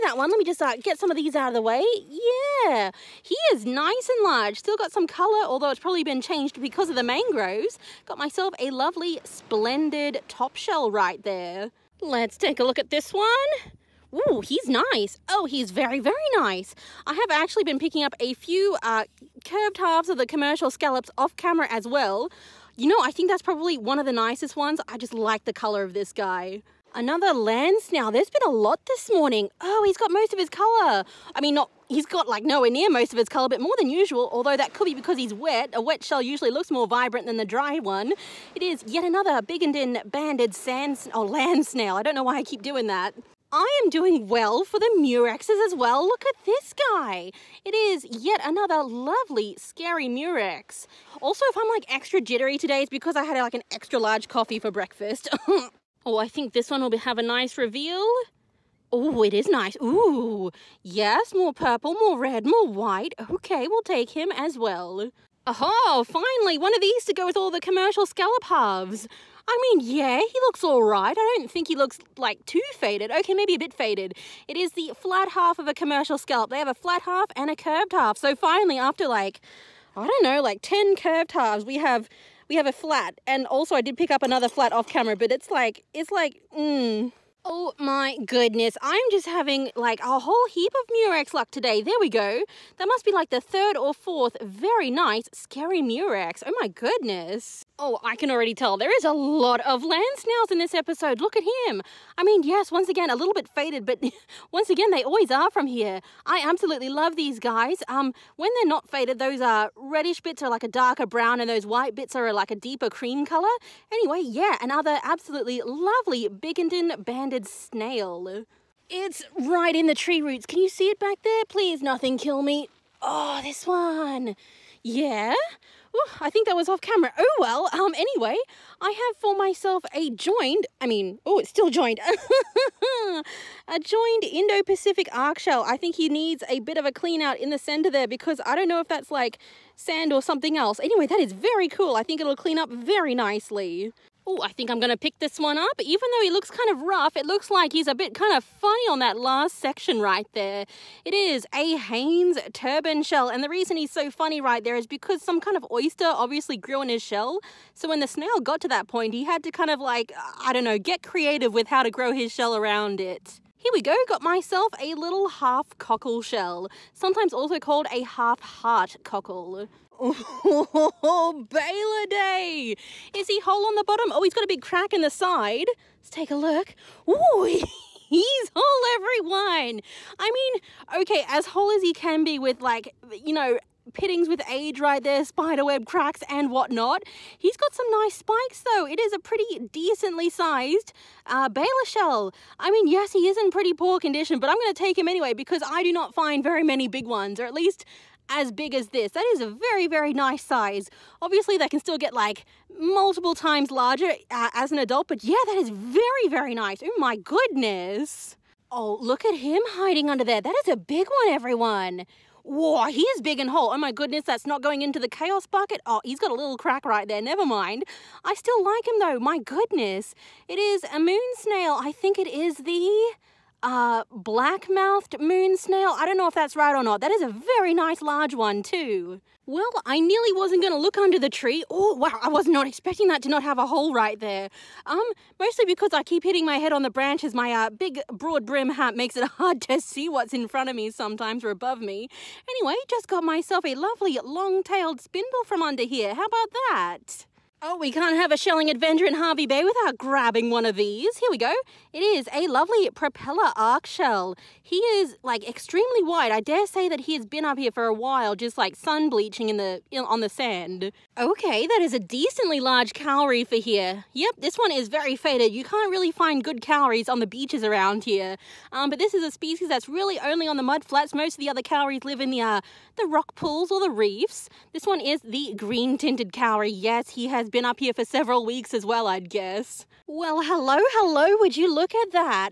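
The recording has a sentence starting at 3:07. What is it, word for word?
He's got some nice spikes though.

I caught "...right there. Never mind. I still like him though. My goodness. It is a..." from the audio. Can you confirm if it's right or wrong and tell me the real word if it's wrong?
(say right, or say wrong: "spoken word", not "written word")
right.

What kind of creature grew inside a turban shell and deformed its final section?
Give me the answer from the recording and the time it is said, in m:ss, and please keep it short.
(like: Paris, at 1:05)
oyster, at 2:35.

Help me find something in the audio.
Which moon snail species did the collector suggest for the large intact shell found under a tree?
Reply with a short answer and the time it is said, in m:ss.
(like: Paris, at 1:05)
black mouthed moon snail, at 3:44.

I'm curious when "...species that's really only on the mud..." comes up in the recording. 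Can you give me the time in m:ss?
4:29.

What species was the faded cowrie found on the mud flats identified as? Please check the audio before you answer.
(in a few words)
green tinted cowrie.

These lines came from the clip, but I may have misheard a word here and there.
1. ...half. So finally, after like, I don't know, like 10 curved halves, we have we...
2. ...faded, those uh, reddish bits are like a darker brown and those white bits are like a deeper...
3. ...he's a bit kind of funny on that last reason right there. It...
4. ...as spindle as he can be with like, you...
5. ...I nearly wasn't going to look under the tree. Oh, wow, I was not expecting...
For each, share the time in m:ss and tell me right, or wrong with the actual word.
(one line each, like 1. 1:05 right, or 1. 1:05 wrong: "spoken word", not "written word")
1. 1:17 right
2. 1:48 right
3. 2:27 wrong: "section", not "reason"
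4. 3:01 wrong: "whole", not "spindle"
5. 3:49 right.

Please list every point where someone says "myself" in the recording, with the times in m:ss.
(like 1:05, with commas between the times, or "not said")
0:08, 2:09, 2:44, 4:03.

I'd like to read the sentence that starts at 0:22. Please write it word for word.
You know, I think that's probably one of the nicest ones.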